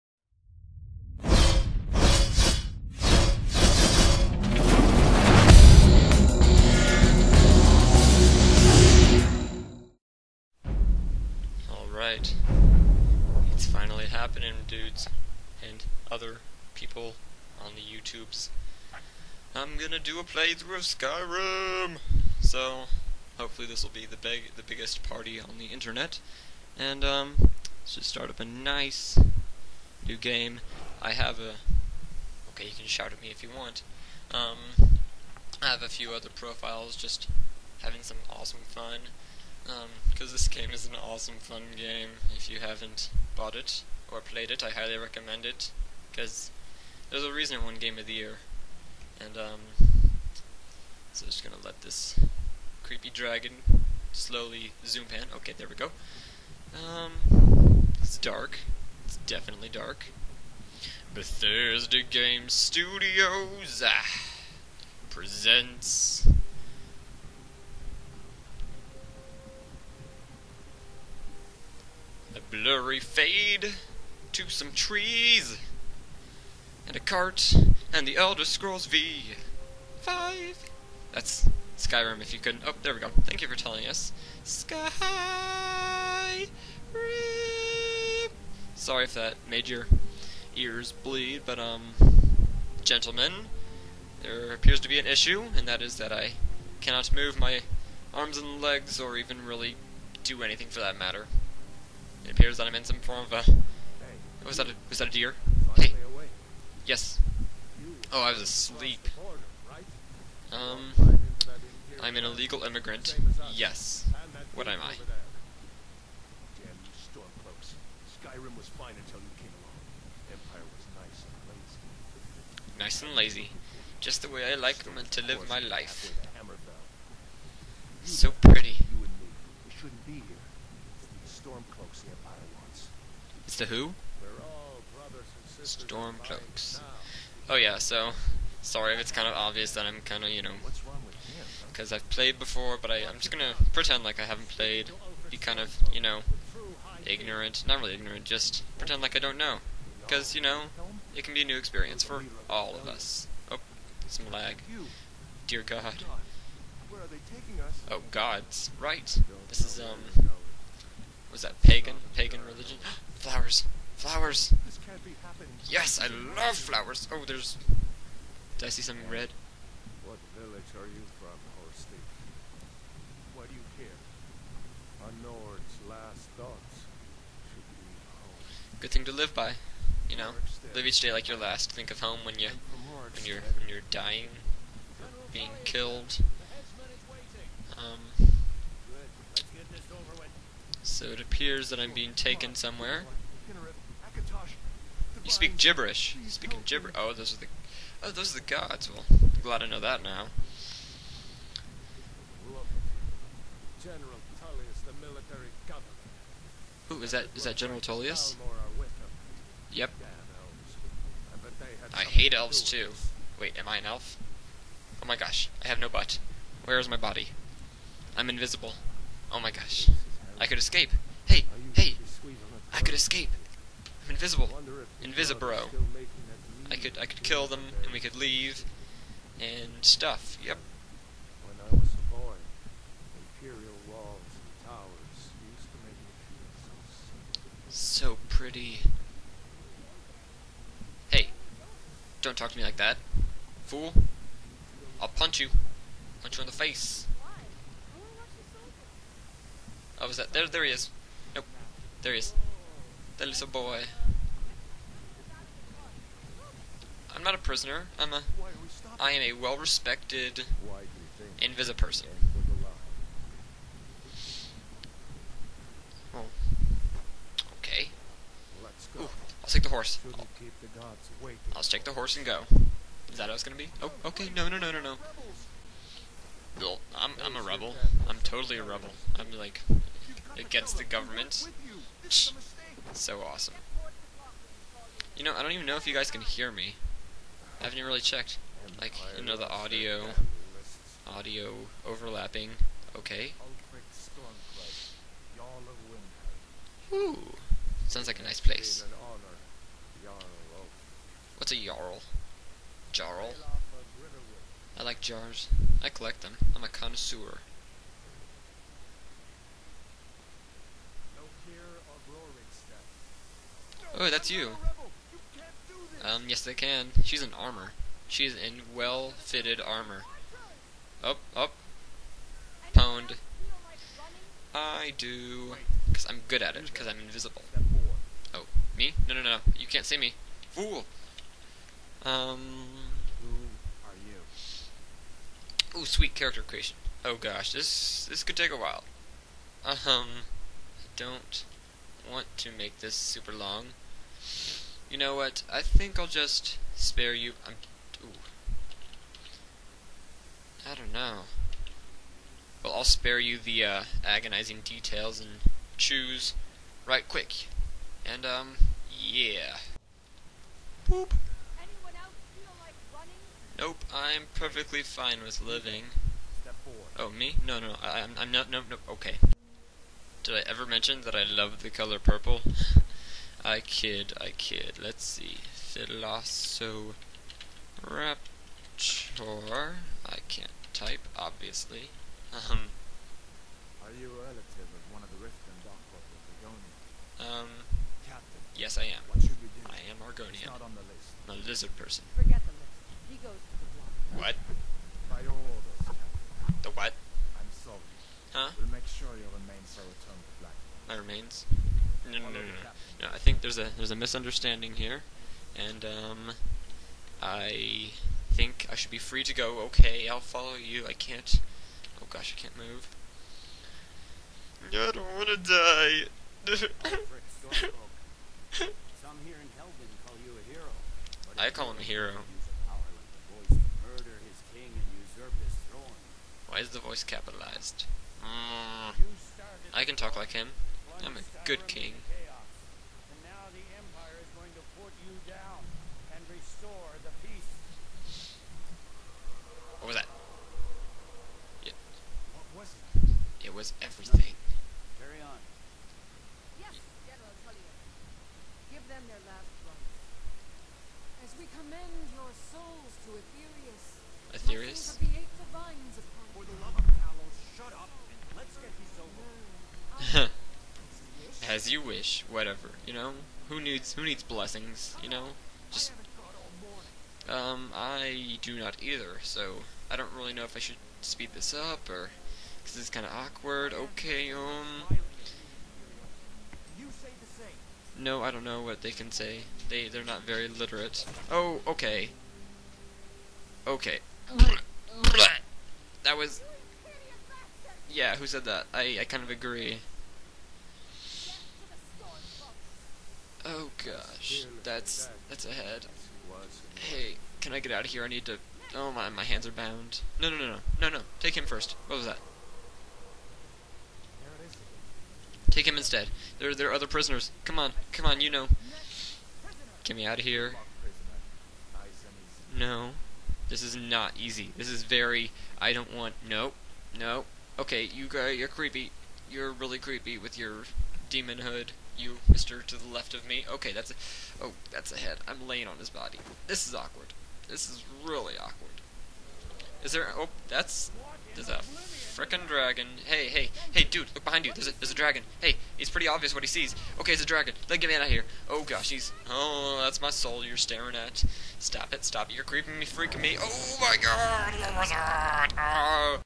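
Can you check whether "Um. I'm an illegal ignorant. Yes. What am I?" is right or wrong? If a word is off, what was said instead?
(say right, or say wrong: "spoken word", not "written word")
wrong: "immigrant", not "ignorant".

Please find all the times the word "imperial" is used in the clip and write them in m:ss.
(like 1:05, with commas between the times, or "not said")
3:53.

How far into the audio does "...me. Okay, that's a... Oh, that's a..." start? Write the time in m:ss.
8:43.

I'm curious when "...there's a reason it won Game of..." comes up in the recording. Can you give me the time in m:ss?
0:47.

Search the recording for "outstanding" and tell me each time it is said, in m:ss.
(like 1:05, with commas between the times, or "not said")
not said.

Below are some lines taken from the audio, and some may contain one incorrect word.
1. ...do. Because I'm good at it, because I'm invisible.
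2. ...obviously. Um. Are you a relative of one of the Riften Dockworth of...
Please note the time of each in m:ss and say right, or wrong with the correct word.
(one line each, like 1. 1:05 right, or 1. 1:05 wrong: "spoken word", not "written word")
1. 5:24 right
2. 6:21 right.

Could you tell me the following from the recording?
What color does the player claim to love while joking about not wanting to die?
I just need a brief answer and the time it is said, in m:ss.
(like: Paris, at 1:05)
purple, at 6:11.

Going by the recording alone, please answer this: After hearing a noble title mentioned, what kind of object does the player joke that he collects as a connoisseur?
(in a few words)
jars.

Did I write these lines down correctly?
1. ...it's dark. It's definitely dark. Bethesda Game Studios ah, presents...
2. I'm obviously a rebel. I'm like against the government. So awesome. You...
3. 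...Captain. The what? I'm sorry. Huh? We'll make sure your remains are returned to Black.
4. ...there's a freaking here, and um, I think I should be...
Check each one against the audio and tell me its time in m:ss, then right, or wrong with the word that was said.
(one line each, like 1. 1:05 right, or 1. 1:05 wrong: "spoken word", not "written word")
1. 0:58 right
2. 4:38 wrong: "totally", not "obviously"
3. 6:35 right
4. 6:43 wrong: "misunderstanding", not "freaking".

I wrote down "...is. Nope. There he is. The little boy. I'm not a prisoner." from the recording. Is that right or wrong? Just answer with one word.
right.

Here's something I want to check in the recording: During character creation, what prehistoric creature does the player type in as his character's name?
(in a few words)
Velociraptor.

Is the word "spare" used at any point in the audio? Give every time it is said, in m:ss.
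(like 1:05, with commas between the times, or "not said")
5:46, 5:52.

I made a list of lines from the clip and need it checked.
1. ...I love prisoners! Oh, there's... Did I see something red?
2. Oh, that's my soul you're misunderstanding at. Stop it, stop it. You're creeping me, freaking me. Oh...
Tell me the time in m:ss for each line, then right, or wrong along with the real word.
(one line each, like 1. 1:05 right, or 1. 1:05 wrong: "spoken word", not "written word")
1. 2:45 wrong: "flowers", not "prisoners"
2. 8:59 wrong: "staring", not "misunderstanding".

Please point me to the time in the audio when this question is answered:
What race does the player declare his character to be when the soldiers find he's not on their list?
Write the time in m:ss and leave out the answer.
6:30.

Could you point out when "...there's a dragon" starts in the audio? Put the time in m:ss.
8:54.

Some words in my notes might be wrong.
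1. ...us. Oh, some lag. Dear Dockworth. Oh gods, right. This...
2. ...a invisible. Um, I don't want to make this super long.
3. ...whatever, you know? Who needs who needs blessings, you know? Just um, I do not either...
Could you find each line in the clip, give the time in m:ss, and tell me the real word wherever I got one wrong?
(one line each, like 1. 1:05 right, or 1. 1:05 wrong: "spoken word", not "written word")
1. 2:32 wrong: "God", not "Dockworth"
2. 5:38 wrong: "while", not "invisible"
3. 7:42 right.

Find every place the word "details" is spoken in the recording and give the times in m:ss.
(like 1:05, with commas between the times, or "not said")
5:54.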